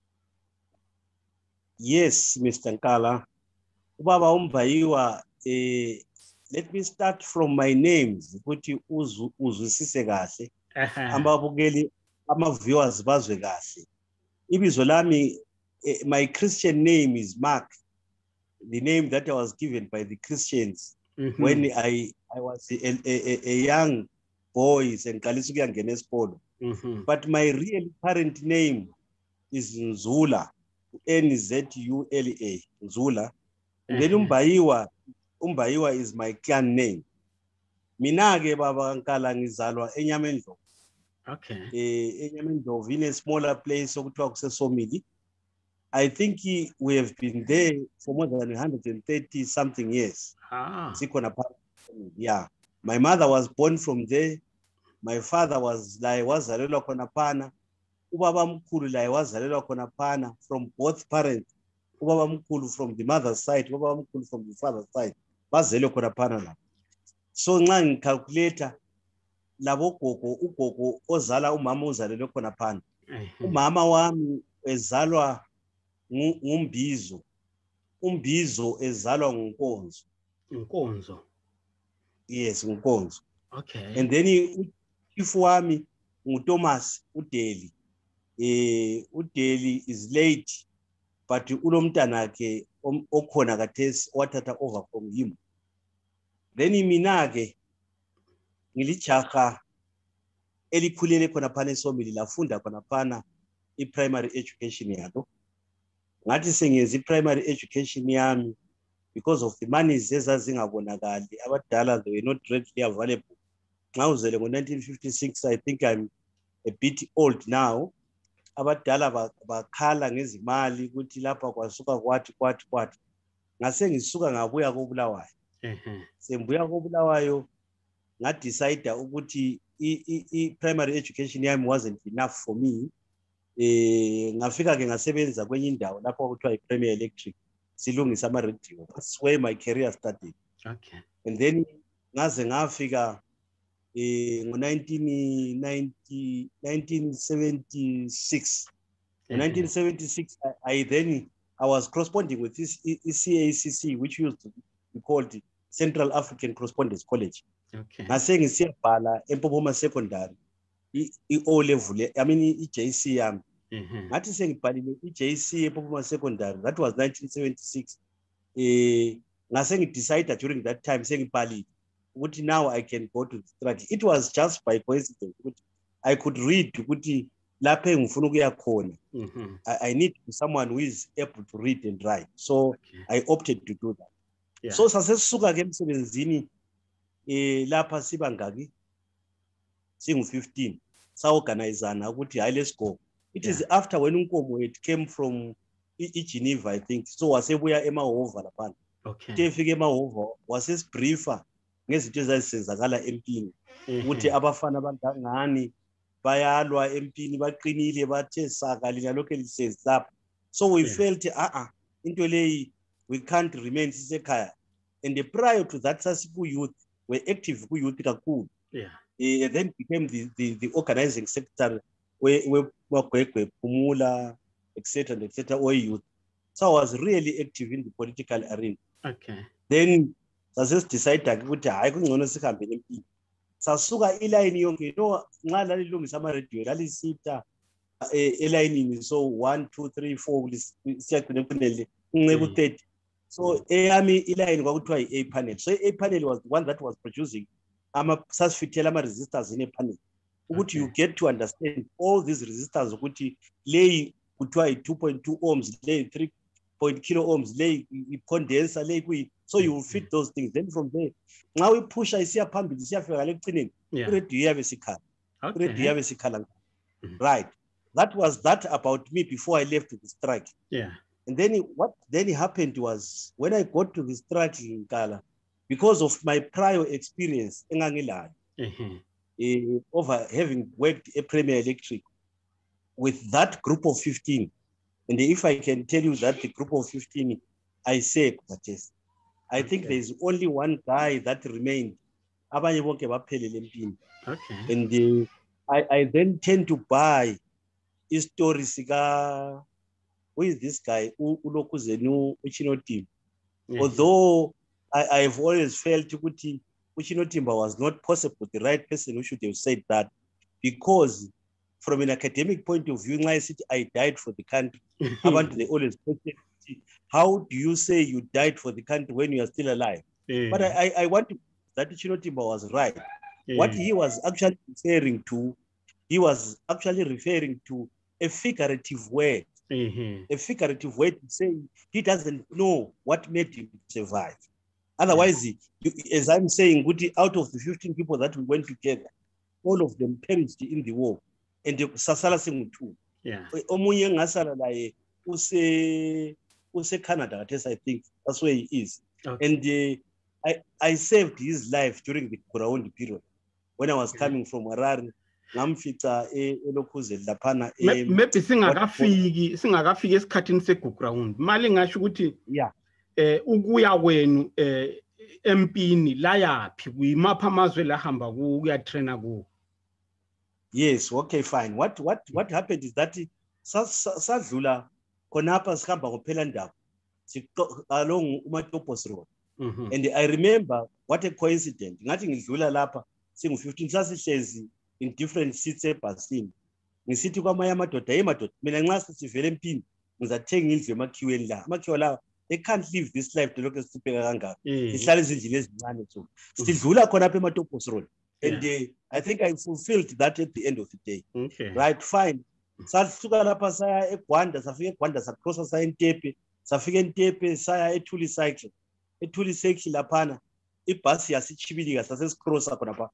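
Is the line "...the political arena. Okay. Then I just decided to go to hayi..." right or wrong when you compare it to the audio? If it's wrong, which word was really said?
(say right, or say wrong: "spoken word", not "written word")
right.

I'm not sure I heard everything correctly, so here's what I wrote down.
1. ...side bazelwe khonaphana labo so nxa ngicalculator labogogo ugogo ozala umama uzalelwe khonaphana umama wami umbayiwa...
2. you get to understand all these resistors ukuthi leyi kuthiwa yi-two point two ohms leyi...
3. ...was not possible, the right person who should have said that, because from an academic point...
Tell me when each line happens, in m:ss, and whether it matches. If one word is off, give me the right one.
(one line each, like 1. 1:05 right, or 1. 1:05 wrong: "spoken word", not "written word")
1. 1:04 wrong: "ezalwa", not "umbayiwa"
2. 4:10 right
3. 5:07 right.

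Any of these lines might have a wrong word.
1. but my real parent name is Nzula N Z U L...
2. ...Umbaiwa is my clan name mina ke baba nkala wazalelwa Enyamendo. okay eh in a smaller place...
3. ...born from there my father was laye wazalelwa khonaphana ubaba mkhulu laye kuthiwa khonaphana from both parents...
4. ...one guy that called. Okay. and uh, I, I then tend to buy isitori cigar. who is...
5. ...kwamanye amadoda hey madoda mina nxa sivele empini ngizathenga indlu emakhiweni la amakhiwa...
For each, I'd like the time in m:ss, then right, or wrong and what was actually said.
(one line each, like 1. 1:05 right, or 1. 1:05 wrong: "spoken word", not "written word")
1. 0:27 right
2. 0:35 wrong: "ngizalwa", not "wazalelwa"
3. 0:53 wrong: "wazalelwa", not "kuthiwa"
4. 4:50 wrong: "remained", not "called"
5. 6:27 right.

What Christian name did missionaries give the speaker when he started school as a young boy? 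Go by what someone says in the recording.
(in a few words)
Mark.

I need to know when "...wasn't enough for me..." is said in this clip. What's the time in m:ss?
2:11.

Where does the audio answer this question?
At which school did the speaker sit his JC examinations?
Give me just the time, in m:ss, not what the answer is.
2:39.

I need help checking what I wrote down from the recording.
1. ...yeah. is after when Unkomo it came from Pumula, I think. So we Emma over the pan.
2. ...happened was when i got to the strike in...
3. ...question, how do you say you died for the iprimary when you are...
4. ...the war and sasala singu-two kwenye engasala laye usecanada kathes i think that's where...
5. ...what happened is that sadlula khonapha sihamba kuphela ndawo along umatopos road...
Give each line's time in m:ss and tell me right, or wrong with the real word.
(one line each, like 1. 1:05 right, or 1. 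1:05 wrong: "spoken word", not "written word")
1. 3:13 wrong: "Geneva", not "Pumula"
2. 4:32 right
3. 5:16 wrong: "country", not "iprimary"
4. 5:40 wrong: "omunye", not "kwenye"
5. 6:12 right.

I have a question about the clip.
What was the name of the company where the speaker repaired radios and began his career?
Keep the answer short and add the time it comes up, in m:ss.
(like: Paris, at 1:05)
Premier Electric, at 2:16.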